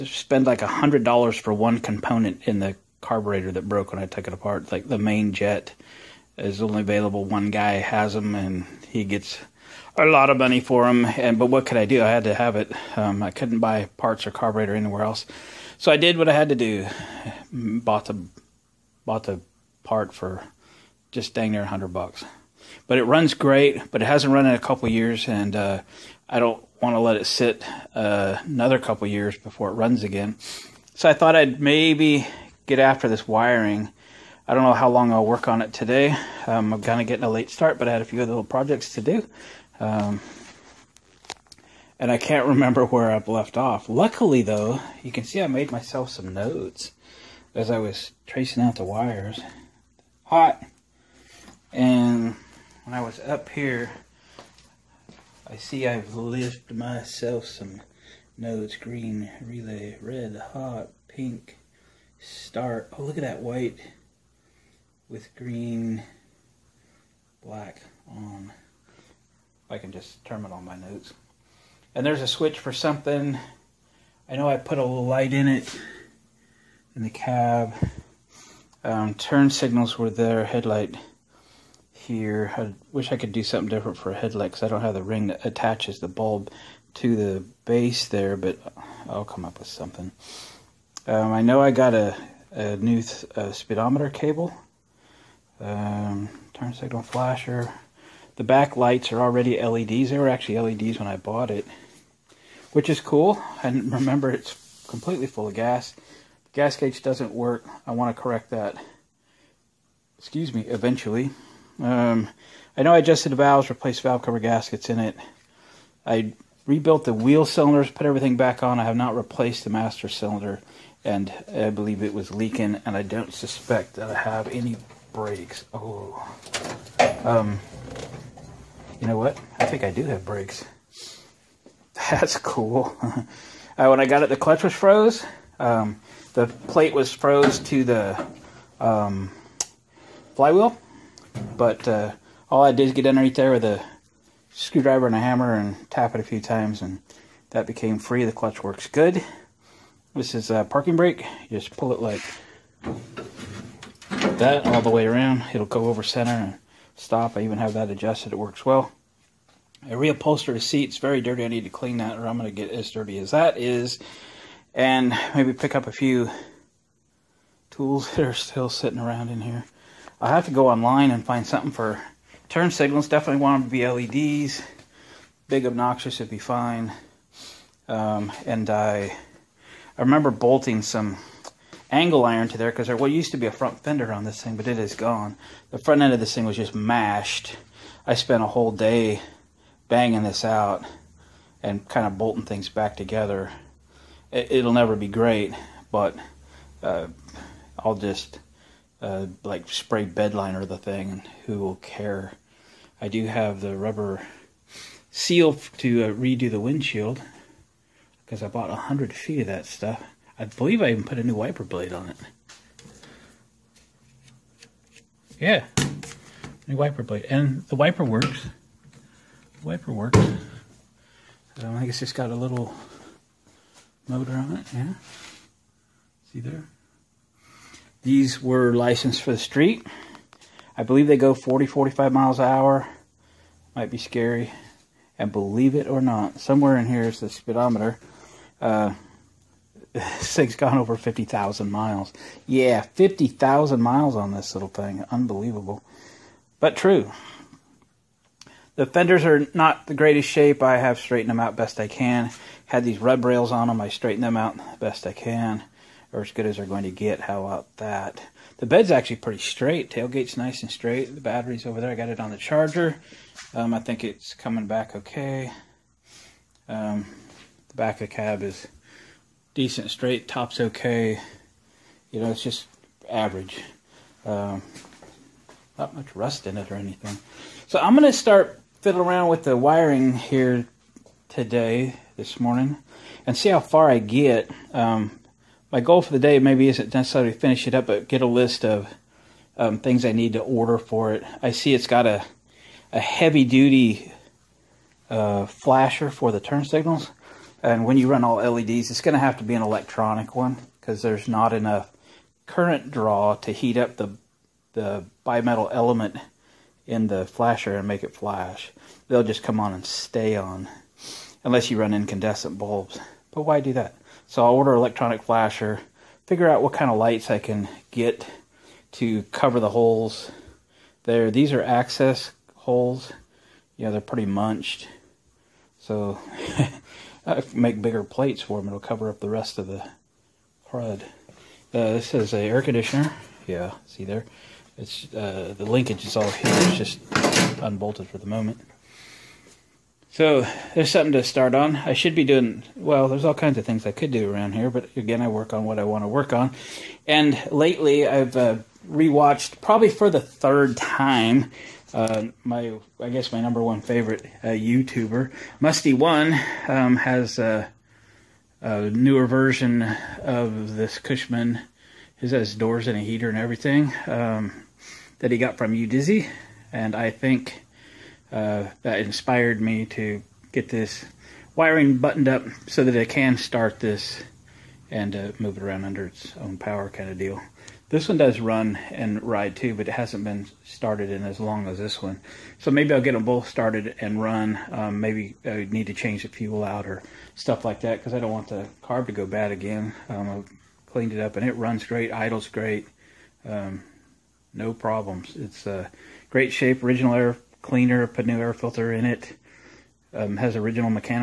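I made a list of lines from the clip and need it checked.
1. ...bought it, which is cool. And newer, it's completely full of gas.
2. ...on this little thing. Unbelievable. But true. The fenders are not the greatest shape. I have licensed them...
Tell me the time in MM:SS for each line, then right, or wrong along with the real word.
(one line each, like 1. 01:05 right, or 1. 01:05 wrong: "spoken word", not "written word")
1. 01:41 wrong: "remember", not "newer"
2. 04:04 wrong: "straightened", not "licensed".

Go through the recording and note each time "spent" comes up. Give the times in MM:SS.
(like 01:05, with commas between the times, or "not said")
03:08.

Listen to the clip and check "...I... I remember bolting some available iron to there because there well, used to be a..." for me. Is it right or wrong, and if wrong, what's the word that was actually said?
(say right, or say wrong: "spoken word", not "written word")
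wrong: "angle", not "available".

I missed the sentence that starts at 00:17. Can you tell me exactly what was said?
Bought the bought the part for just dang near a hundred bucks.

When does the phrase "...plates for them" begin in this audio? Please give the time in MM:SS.
05:28.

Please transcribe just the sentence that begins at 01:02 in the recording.
Oh, look at that white with green, black on.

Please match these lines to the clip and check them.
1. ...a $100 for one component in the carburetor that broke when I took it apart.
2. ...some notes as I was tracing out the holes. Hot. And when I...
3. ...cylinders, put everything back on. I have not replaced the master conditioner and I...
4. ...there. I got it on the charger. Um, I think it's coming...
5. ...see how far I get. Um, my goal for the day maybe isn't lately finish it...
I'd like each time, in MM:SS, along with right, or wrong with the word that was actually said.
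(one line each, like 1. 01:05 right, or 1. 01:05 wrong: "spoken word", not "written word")
1. 00:00 right
2. 00:46 wrong: "wires", not "holes"
3. 01:57 wrong: "cylinder", not "conditioner"
4. 04:21 right
5. 04:43 wrong: "necessarily", not "lately".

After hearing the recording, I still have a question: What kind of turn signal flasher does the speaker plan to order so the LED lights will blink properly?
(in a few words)
electronic flasher.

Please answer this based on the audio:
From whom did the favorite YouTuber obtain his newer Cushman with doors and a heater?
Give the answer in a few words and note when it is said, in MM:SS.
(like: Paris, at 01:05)
Udizzy, at 06:05.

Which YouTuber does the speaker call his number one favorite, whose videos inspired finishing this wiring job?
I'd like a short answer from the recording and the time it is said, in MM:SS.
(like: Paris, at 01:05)
Mustie1, at 05:55.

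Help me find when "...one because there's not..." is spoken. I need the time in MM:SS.
05:00.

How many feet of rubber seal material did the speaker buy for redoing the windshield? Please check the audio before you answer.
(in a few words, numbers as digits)
100 feet.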